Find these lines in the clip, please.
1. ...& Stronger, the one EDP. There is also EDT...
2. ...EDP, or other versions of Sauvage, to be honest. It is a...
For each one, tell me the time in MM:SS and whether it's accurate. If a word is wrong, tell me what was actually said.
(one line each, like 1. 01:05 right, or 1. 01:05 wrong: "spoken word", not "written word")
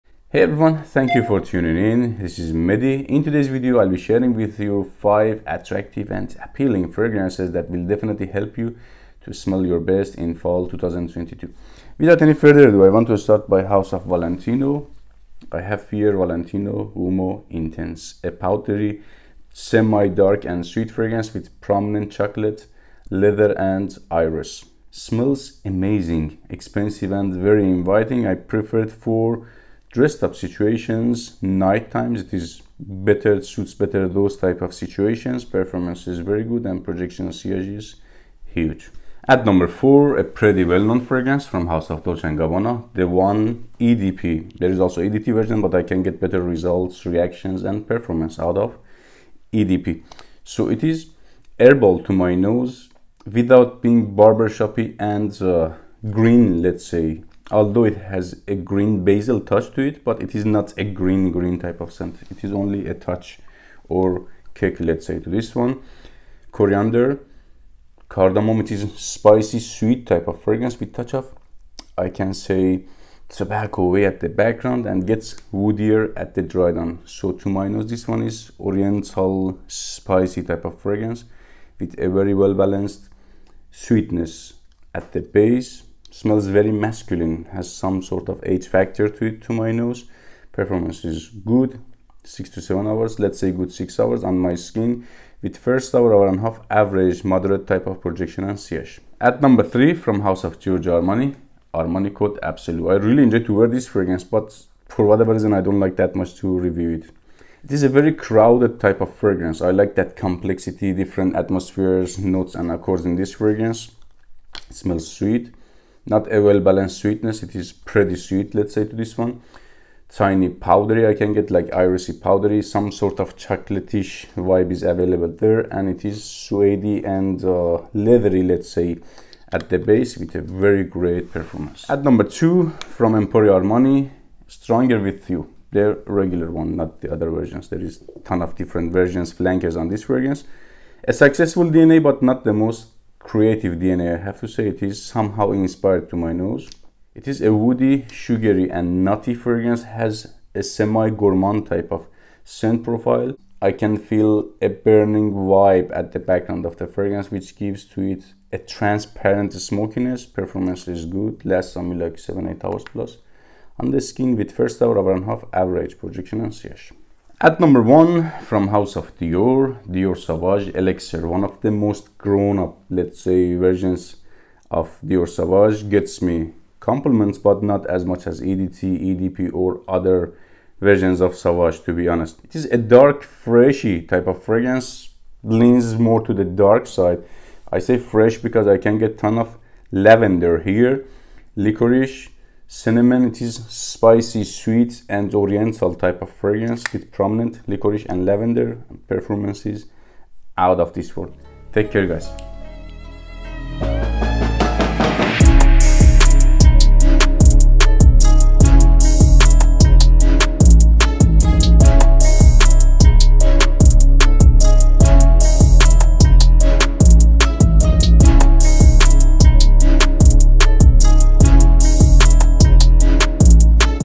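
1. 00:42 wrong: "Gabbana", not "Stronger"
2. 02:58 right.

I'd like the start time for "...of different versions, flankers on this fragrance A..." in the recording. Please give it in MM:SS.
02:18.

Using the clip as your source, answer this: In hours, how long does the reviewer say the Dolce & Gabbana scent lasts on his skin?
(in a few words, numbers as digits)
6 hours.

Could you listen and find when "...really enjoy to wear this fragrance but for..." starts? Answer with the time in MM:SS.
01:42.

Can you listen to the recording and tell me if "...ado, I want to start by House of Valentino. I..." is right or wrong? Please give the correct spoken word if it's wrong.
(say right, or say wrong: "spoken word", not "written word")
right.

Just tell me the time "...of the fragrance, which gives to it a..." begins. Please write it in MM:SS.
02:36.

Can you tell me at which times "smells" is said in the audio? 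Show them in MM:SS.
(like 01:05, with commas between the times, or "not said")
00:09, 00:24, 01:26, 01:54.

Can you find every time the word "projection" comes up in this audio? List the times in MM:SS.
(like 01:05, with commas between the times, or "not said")
00:36, 01:38, 02:45.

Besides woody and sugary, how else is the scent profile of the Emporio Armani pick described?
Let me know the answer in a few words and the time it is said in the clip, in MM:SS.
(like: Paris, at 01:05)
Nutty, at 02:29.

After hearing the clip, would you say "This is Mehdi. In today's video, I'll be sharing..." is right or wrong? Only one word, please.
right.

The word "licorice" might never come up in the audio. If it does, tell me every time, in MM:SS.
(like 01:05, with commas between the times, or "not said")
03:11, 03:17.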